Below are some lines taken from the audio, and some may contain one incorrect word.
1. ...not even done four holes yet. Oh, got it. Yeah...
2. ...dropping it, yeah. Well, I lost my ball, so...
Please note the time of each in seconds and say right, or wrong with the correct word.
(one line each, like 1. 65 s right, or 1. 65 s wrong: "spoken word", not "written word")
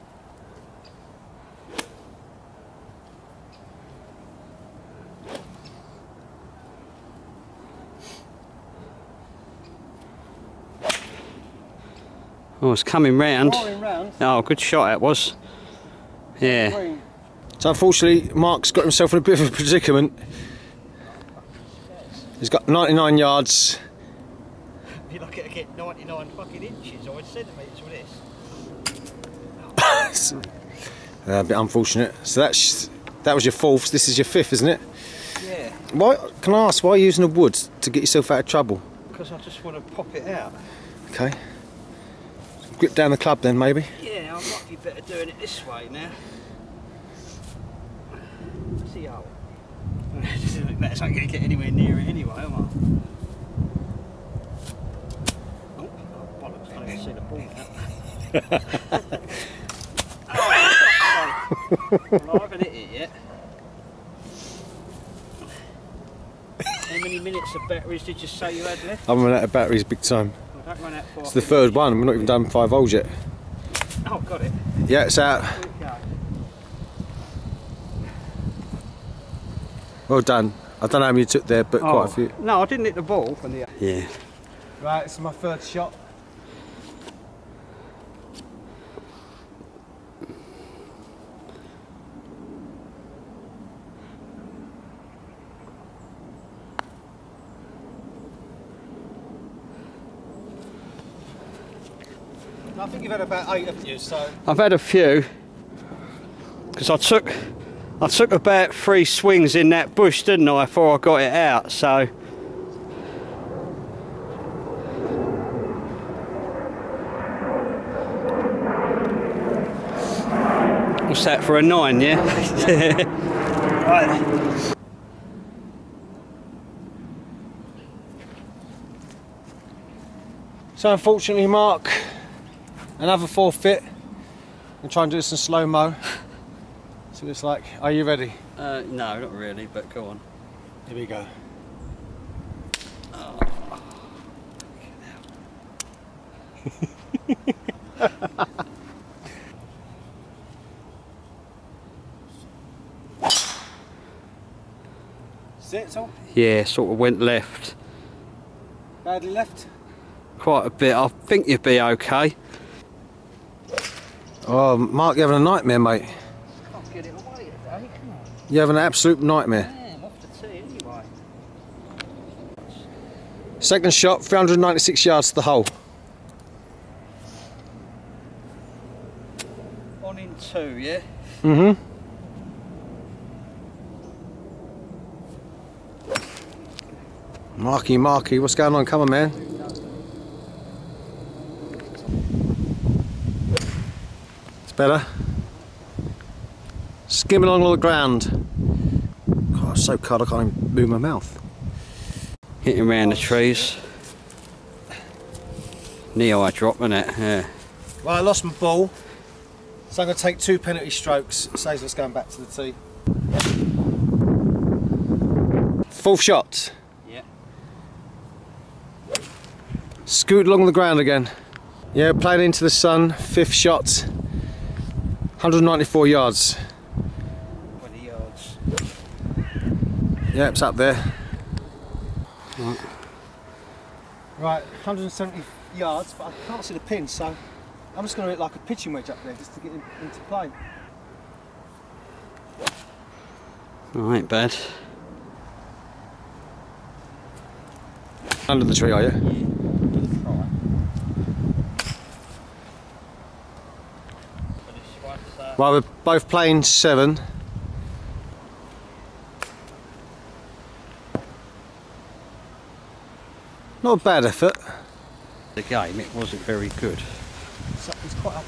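1. 72 s wrong: "five", not "four"
2. 206 s right.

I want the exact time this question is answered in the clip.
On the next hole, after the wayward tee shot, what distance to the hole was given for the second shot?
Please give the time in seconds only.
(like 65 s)
174 s.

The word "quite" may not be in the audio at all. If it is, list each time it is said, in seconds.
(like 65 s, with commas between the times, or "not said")
81 s, 160 s.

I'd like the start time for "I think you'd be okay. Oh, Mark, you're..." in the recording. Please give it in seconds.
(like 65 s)
160 s.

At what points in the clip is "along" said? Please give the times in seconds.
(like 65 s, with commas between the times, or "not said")
197 s, 220 s.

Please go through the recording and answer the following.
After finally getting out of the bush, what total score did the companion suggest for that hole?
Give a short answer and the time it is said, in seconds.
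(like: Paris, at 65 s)
9, at 121 s.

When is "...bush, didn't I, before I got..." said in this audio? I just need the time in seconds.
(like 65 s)
109 s.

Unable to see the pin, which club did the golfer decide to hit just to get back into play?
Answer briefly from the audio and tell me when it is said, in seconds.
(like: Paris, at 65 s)
pitching wedge, at 238 s.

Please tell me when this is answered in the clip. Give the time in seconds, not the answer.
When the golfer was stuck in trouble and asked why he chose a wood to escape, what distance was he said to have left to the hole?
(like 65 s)
22 s.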